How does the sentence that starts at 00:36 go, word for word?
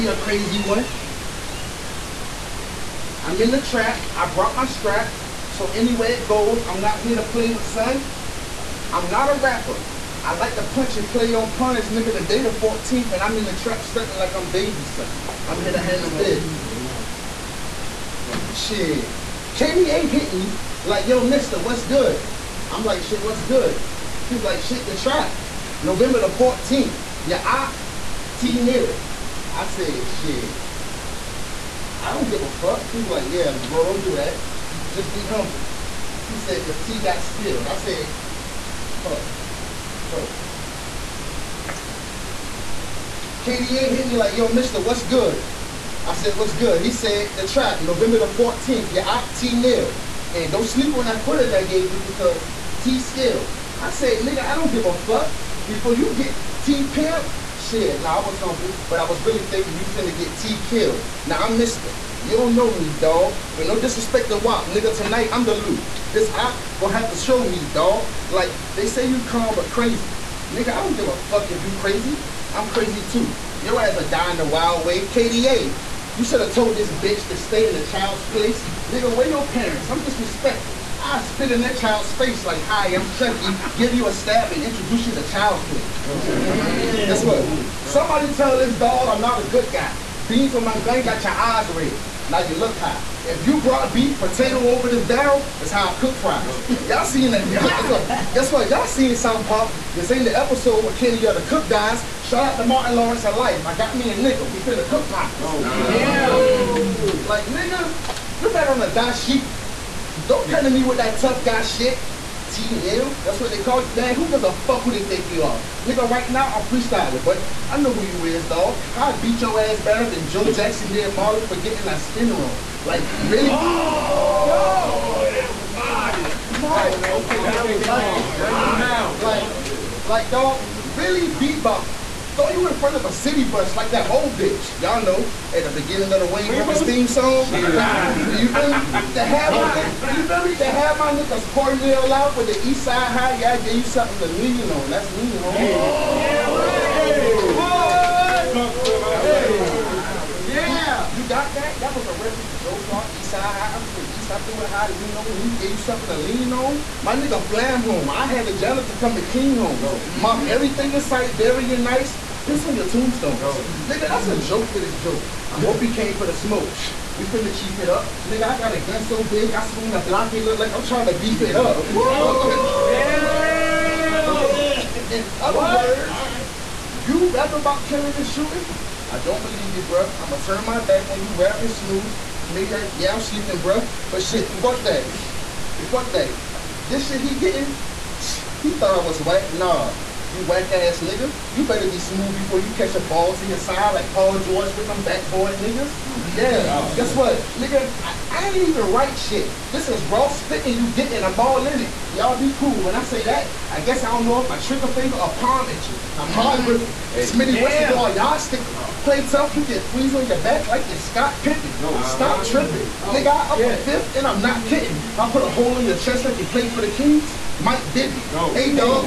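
He said, because T got skills.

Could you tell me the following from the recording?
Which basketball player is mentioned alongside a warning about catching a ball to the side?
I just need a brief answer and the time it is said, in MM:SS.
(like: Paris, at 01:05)
Paul George, at 03:14.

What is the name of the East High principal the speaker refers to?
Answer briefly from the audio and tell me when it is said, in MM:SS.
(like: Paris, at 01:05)
Joe Clark, at 02:32.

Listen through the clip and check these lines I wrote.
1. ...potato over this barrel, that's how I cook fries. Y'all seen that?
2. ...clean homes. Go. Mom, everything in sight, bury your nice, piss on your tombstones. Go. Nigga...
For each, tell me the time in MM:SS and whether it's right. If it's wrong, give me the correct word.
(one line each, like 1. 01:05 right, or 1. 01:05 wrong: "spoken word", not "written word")
1. 01:34 right
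2. 02:39 right.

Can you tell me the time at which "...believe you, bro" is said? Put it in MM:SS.
02:59.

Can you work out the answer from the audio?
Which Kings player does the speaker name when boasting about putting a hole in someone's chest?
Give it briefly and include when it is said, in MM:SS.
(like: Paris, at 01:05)
Mike Bibby, at 03:37.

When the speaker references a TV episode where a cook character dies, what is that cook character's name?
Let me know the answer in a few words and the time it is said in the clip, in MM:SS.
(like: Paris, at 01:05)
Kenny, at 01:40.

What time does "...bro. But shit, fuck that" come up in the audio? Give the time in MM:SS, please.
03:03.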